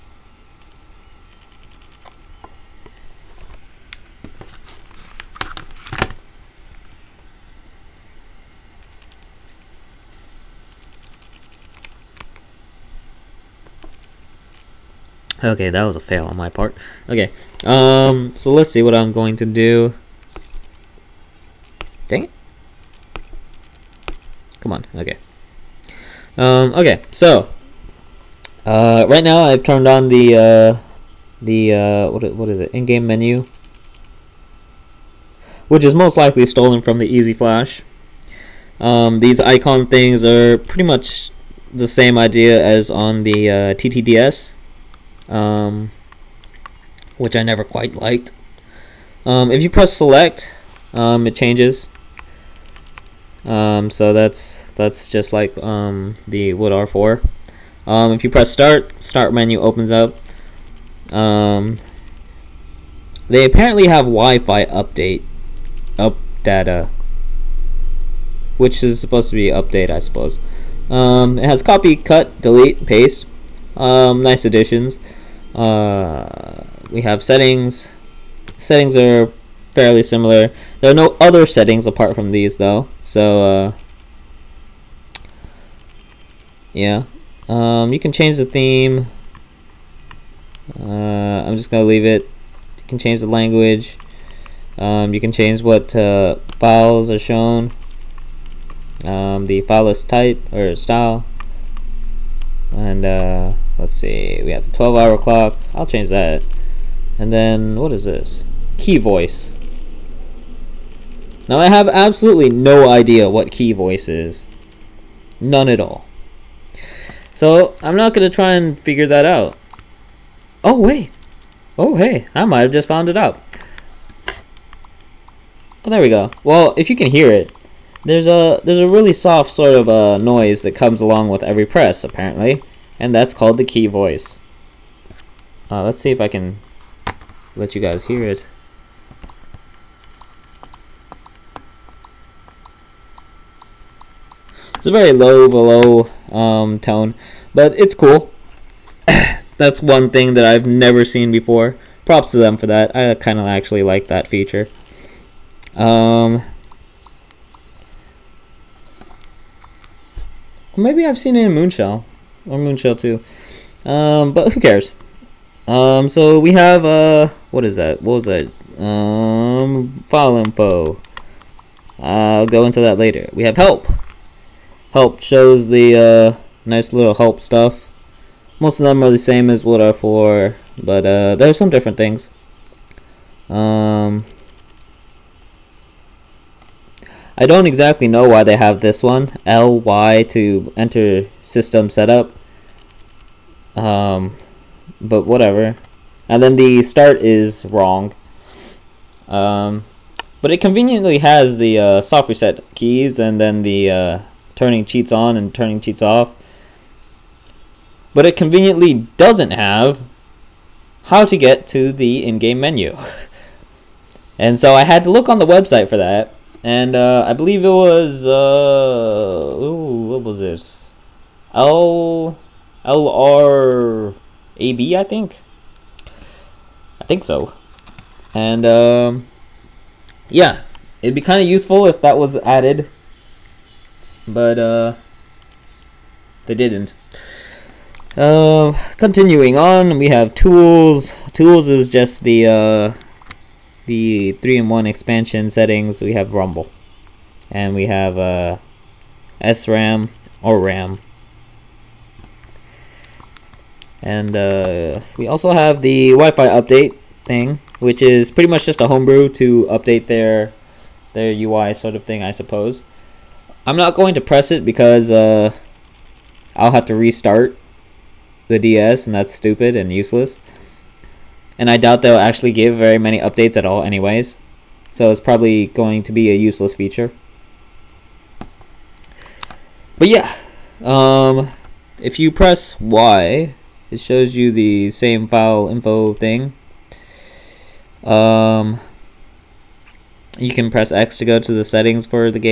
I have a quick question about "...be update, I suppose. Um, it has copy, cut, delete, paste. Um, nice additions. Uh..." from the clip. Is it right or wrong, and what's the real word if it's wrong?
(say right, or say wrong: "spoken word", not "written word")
right.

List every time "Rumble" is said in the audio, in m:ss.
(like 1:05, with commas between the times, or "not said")
4:06.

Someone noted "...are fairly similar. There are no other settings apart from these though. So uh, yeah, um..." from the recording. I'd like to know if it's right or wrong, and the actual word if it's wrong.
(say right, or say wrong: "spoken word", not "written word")
right.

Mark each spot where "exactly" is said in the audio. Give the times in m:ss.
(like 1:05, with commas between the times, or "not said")
3:07.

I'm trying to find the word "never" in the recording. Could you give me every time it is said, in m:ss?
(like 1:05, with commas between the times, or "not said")
0:47, 2:30.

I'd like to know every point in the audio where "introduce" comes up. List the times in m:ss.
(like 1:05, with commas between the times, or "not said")
not said.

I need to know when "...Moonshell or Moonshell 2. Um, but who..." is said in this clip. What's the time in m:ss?
2:41.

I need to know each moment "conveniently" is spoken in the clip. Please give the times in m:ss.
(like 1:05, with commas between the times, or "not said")
3:20, 3:28.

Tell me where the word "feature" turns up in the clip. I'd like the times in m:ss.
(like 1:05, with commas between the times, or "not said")
2:34, 4:36.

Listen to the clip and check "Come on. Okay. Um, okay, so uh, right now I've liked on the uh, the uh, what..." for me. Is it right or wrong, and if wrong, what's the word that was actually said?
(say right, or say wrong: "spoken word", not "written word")
wrong: "turned", not "liked".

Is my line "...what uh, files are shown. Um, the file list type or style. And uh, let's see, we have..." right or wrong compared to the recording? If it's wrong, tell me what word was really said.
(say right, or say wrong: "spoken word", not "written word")
right.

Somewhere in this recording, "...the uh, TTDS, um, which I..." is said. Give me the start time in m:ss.
0:43.